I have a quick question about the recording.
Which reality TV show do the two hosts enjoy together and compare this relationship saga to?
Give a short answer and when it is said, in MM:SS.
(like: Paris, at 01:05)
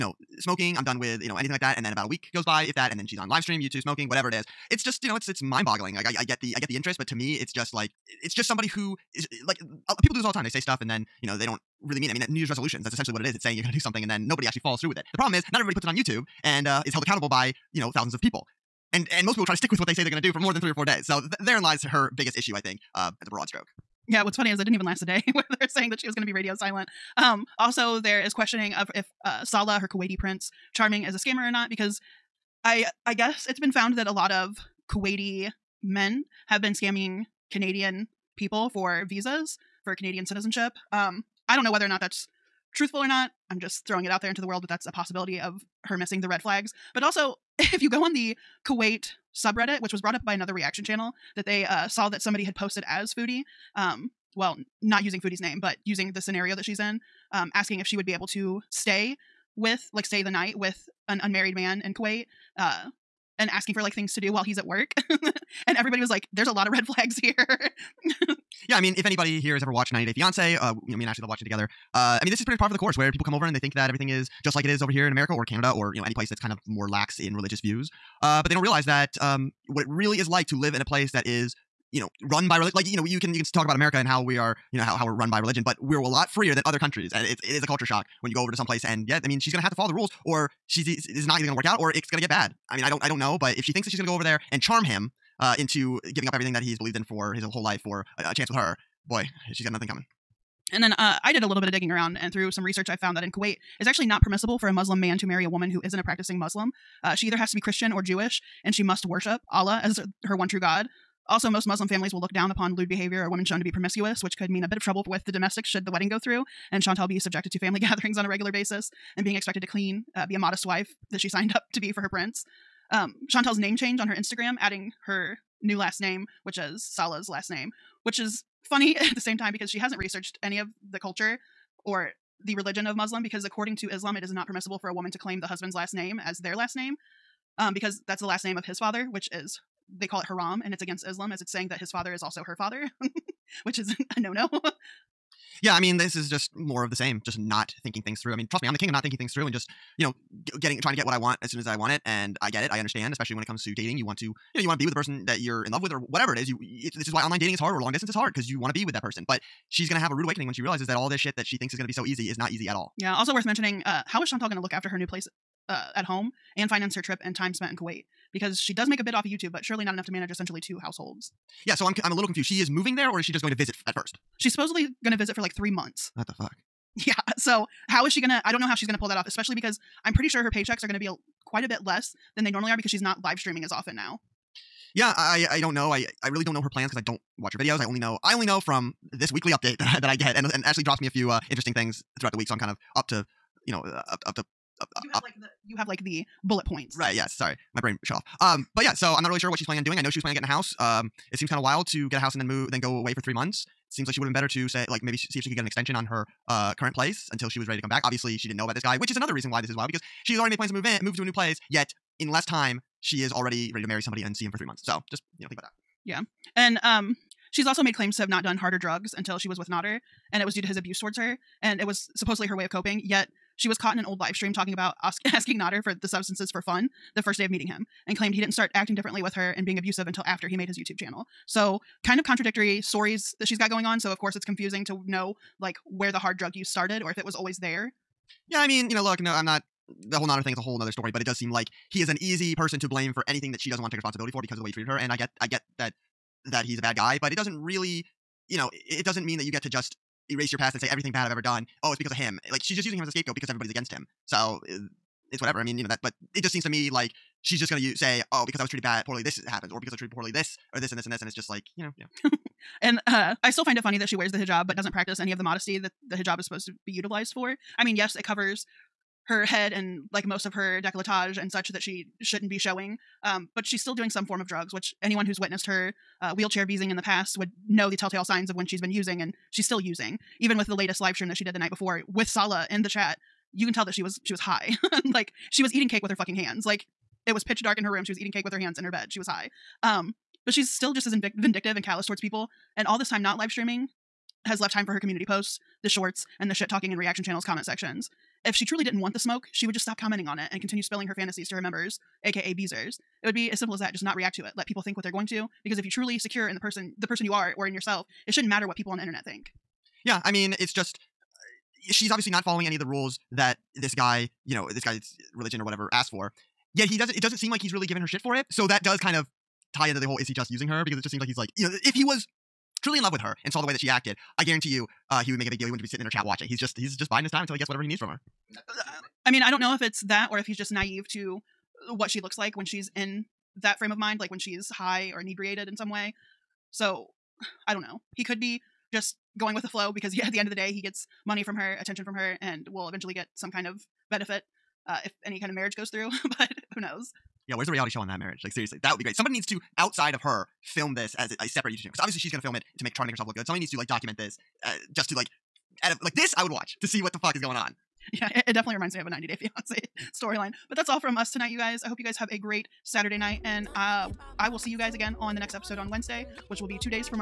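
90 Day Fiance, at 01:09.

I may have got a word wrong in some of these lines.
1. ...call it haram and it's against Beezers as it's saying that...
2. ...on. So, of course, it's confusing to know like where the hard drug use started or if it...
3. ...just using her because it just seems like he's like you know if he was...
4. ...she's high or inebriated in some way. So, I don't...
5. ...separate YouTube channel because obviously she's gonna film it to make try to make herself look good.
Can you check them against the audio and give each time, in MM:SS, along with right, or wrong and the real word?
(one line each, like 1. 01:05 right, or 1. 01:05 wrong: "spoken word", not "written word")
1. 02:20 wrong: "Islam", not "Beezers"
2. 03:53 right
3. 05:20 right
4. 05:34 right
5. 05:51 right.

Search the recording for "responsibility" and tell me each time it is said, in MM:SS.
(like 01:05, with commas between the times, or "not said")
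04:03.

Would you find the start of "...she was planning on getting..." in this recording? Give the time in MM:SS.
03:20.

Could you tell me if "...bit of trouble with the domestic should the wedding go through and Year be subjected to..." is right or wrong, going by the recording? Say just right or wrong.
wrong.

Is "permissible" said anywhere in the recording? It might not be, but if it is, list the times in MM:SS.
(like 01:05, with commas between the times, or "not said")
01:44, 02:14.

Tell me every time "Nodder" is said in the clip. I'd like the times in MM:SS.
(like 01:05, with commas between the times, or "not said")
03:39, 03:45, 04:00.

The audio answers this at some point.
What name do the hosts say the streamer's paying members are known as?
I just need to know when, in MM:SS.
05:02.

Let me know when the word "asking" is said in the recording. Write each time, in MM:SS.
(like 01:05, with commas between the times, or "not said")
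00:57, 01:03, 03:45.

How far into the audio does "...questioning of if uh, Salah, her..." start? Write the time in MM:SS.
00:28.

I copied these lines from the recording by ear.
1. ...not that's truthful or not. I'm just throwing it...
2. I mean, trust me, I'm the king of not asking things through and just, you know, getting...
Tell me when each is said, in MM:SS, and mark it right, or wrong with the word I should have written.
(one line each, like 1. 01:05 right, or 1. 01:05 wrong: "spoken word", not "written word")
1. 00:41 right
2. 02:28 wrong: "thinking", not "asking".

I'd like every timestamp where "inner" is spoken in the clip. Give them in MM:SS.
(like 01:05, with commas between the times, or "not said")
not said.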